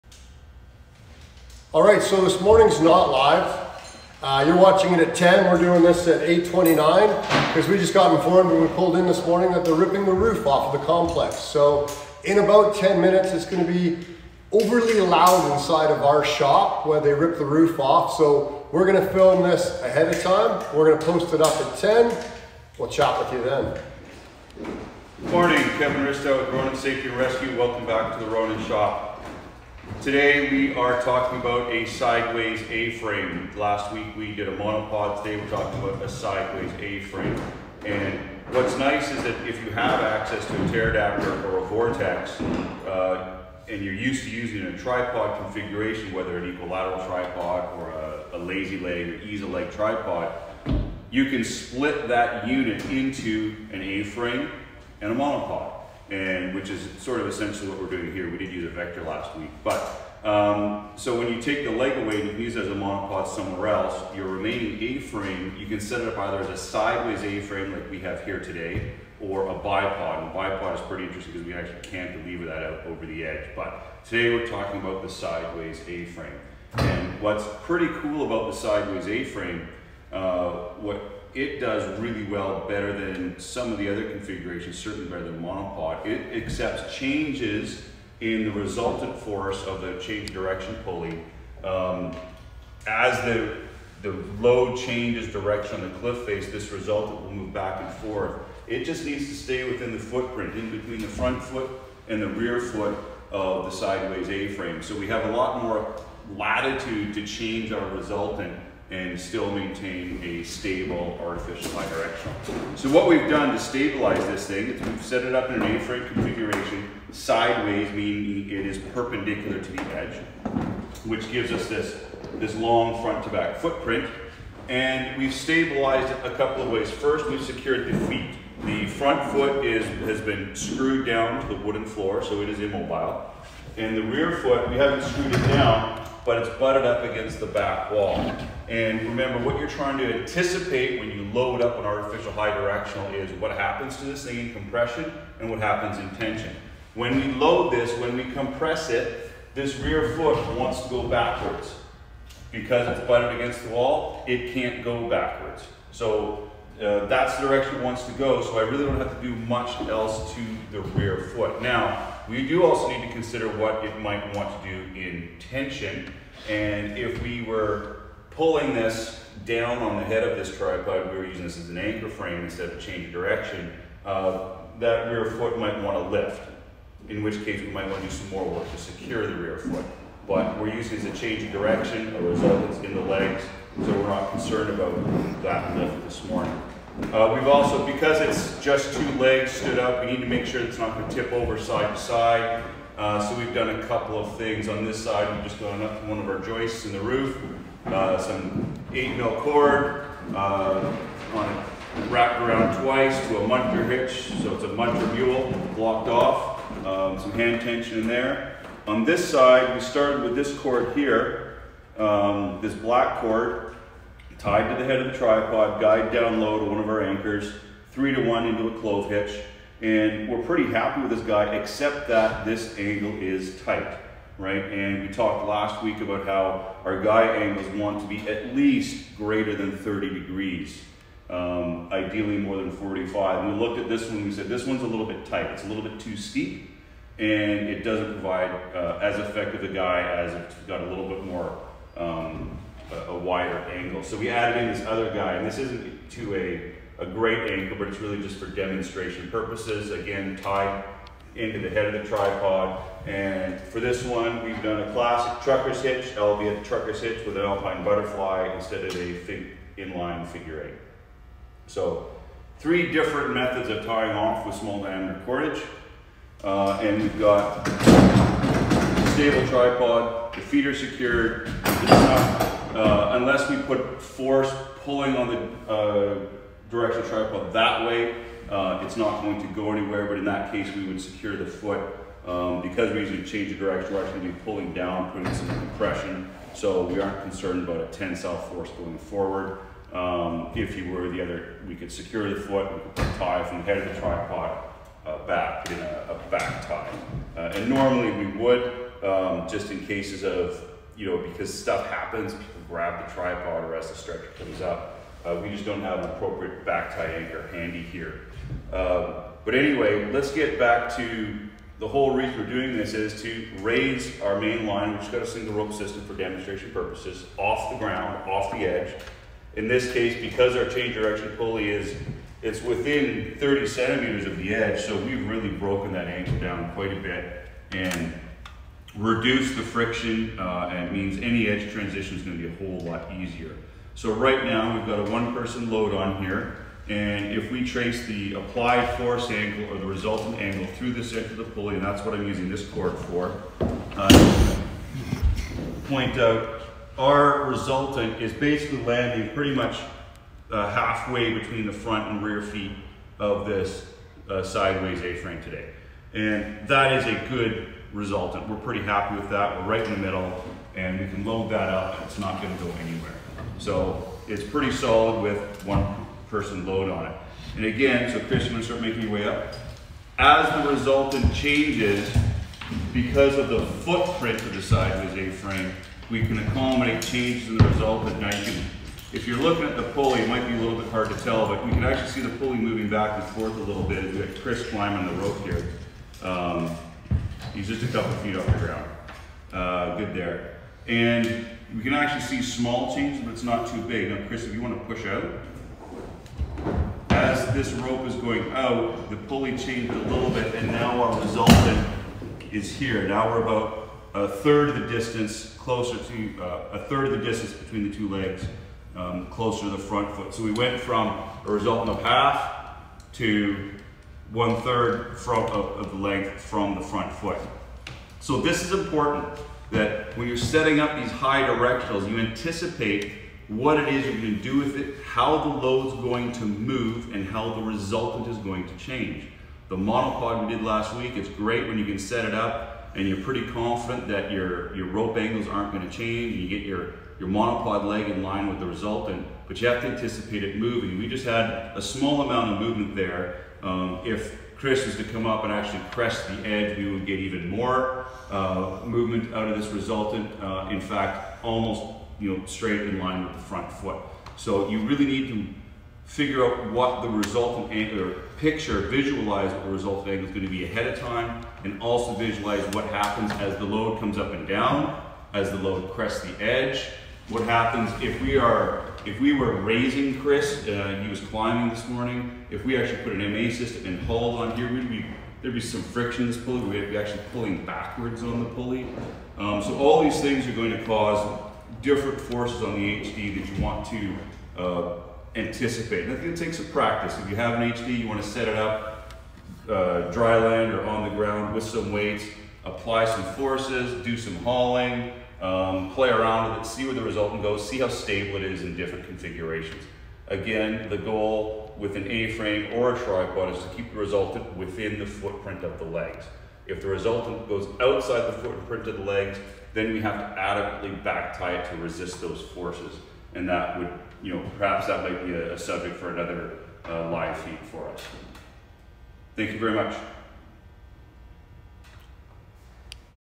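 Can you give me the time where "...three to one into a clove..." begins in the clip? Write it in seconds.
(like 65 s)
217 s.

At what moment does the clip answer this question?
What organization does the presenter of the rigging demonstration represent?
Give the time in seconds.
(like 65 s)
26 s.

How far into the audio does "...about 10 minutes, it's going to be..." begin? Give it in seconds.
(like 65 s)
12 s.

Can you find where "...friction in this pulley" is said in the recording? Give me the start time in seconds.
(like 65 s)
475 s.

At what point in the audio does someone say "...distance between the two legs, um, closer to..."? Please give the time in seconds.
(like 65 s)
407 s.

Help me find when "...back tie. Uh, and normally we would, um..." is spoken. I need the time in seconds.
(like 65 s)
296 s.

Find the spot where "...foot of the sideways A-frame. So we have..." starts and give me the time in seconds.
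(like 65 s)
102 s.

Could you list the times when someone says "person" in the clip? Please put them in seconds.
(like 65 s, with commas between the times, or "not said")
335 s, 366 s.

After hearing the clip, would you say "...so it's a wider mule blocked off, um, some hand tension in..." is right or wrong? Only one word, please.
wrong.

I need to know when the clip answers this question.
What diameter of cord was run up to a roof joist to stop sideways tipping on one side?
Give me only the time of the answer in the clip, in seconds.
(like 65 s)
198 s.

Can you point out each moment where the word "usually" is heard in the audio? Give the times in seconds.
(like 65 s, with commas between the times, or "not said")
282 s.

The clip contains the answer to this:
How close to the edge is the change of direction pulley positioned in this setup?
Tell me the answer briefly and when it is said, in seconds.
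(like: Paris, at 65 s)
Within 30 centimeters, at 322 s.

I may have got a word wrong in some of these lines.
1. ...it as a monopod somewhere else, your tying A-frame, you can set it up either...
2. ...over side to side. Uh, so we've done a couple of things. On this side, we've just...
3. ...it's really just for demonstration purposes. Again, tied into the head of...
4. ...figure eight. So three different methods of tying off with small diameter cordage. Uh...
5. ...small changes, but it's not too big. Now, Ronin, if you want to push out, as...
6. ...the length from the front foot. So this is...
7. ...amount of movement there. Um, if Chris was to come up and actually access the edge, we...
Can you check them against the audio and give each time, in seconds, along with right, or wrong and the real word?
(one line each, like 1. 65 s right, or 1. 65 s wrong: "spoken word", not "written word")
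1. 62 s wrong: "remaining", not "tying"
2. 191 s right
3. 247 s right
4. 260 s right
5. 392 s wrong: "Chris", not "Ronin"
6. 415 s right
7. 442 s wrong: "press", not "access".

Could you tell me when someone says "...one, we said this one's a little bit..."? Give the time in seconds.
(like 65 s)
234 s.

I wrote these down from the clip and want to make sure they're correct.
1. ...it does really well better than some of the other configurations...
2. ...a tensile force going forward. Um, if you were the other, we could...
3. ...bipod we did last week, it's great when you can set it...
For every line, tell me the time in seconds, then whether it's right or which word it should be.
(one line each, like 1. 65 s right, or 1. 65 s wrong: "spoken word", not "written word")
1. 81 s right
2. 287 s right
3. 429 s wrong: "monopod", not "bipod".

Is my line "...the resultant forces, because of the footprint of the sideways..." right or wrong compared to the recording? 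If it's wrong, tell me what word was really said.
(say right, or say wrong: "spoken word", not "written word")
wrong: "changes", not "forces".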